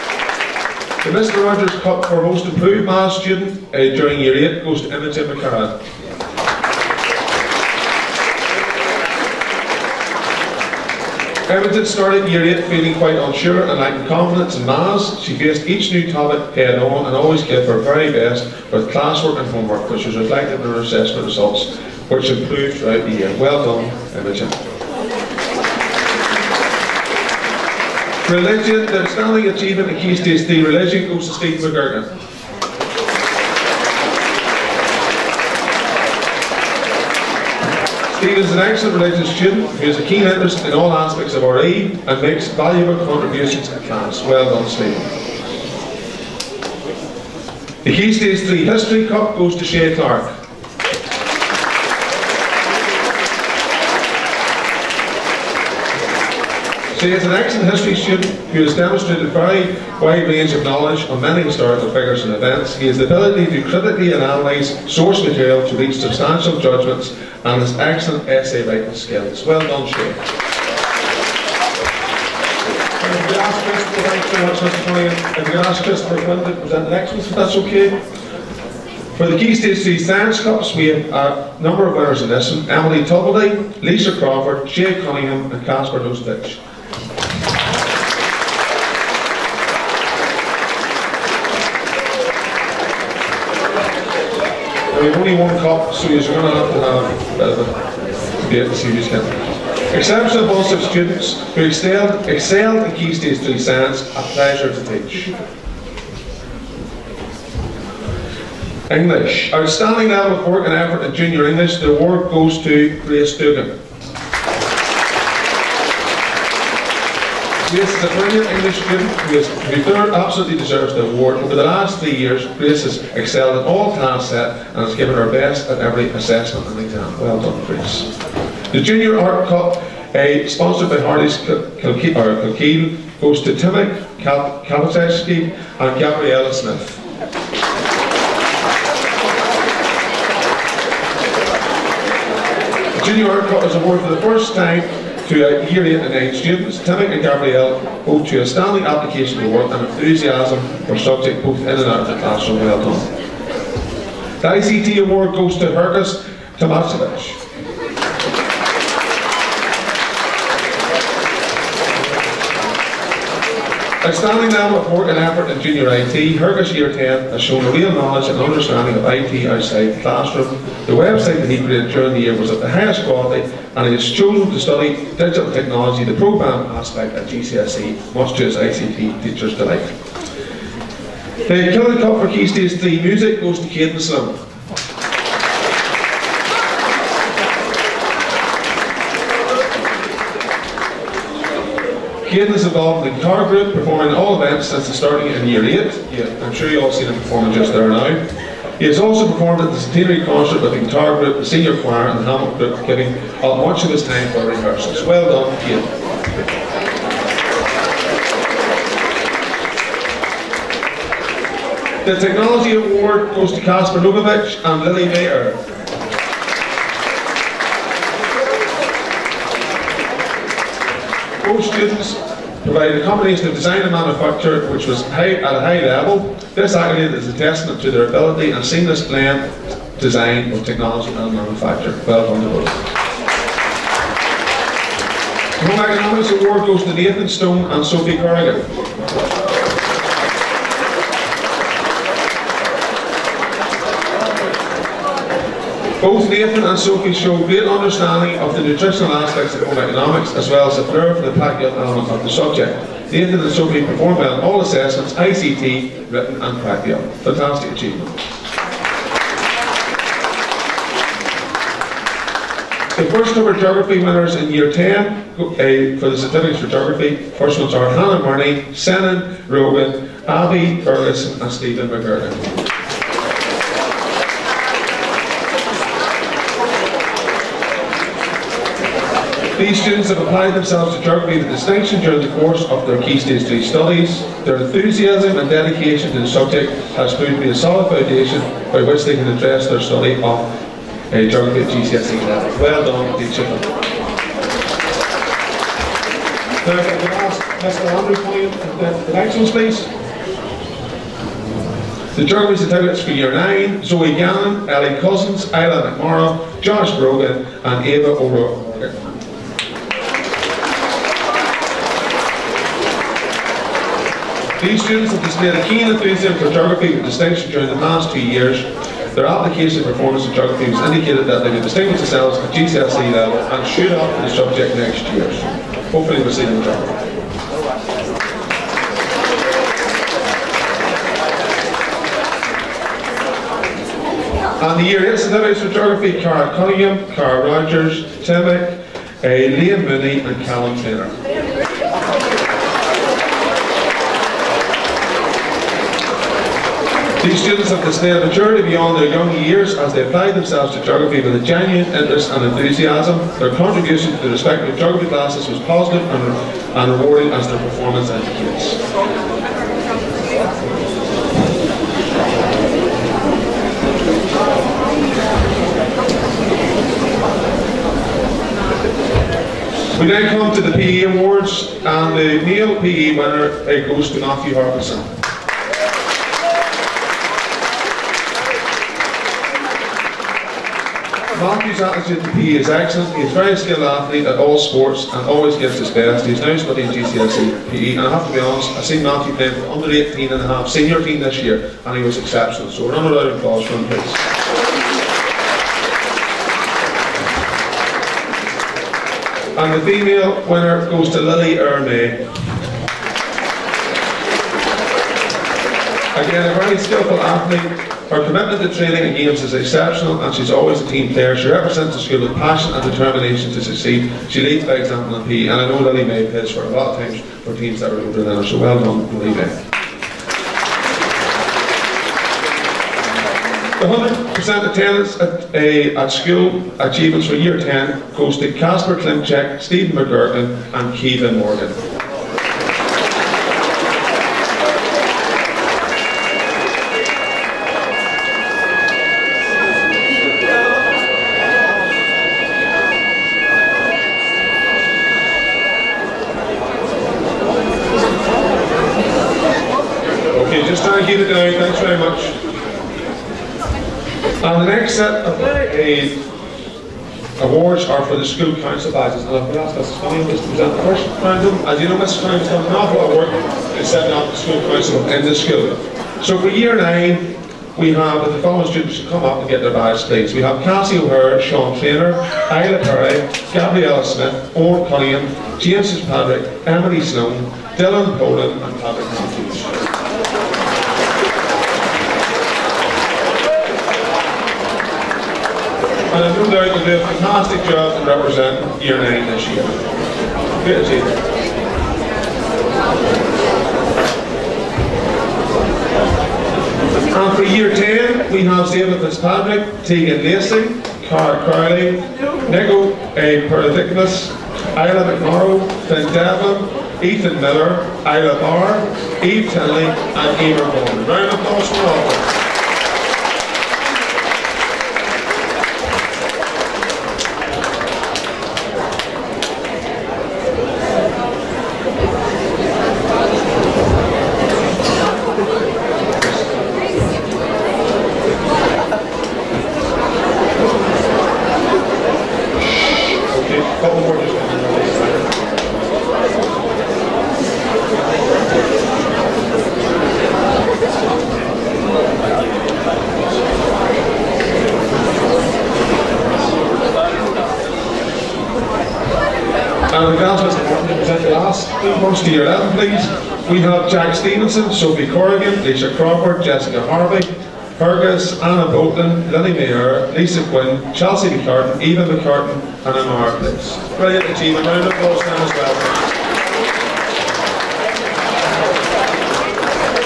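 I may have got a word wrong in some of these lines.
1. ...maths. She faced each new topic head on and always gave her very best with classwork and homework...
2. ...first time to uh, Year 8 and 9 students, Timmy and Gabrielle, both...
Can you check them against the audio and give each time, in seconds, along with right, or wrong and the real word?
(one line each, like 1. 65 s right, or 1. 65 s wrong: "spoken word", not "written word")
1. 14 s right
2. 144 s right.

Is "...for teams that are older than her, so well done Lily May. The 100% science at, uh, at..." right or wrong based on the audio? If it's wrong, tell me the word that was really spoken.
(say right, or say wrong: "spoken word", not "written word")
wrong: "attendance", not "science".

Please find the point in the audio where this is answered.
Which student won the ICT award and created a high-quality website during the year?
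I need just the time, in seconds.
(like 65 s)
155 s.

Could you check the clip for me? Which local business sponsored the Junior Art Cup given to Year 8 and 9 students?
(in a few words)
Harleys Kilkeel.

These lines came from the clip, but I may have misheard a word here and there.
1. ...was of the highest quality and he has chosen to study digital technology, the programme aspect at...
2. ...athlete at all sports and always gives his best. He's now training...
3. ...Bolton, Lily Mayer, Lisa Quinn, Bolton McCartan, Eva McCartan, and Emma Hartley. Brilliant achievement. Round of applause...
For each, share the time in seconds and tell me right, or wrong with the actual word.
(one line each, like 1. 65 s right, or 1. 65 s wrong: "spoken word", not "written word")
1. 172 s right
2. 383 s wrong: "studying", not "training"
3. 558 s wrong: "Chelsea", not "Bolton".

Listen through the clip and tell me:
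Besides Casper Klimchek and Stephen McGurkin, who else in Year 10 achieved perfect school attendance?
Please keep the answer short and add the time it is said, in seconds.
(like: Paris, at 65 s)
Kevin Morgan, at 430 s.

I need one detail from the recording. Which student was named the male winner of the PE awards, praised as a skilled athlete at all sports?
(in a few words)
Matthew Harbison.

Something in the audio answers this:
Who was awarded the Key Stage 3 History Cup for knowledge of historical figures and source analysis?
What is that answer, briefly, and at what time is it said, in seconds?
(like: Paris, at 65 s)
Shea Clark, at 49 s.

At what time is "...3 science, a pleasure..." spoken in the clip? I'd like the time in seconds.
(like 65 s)
103 s.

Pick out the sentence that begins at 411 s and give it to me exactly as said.
She represents the school with passion and determination to succeed.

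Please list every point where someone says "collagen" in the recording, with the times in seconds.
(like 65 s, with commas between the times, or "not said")
not said.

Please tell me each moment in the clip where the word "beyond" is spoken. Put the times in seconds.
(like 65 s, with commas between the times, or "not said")
348 s.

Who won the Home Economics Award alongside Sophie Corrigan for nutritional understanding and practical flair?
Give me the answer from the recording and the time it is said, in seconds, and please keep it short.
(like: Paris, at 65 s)
Nathan Stone, at 236 s.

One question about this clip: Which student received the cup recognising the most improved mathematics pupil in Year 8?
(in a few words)
Imogen McCarran.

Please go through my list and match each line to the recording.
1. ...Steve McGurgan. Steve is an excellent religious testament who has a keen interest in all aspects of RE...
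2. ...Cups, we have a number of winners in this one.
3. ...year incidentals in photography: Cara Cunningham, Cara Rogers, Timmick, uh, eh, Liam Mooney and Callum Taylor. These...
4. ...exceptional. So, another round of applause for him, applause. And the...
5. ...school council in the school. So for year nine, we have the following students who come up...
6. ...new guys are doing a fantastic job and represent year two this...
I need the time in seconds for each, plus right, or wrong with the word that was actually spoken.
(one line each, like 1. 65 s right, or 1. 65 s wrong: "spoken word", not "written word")
1. 31 s wrong: "student", not "testament"
2. 80 s right
3. 334 s right
4. 392 s wrong: "please", not "applause"
5. 464 s right
6. 486 s wrong: "nine", not "two".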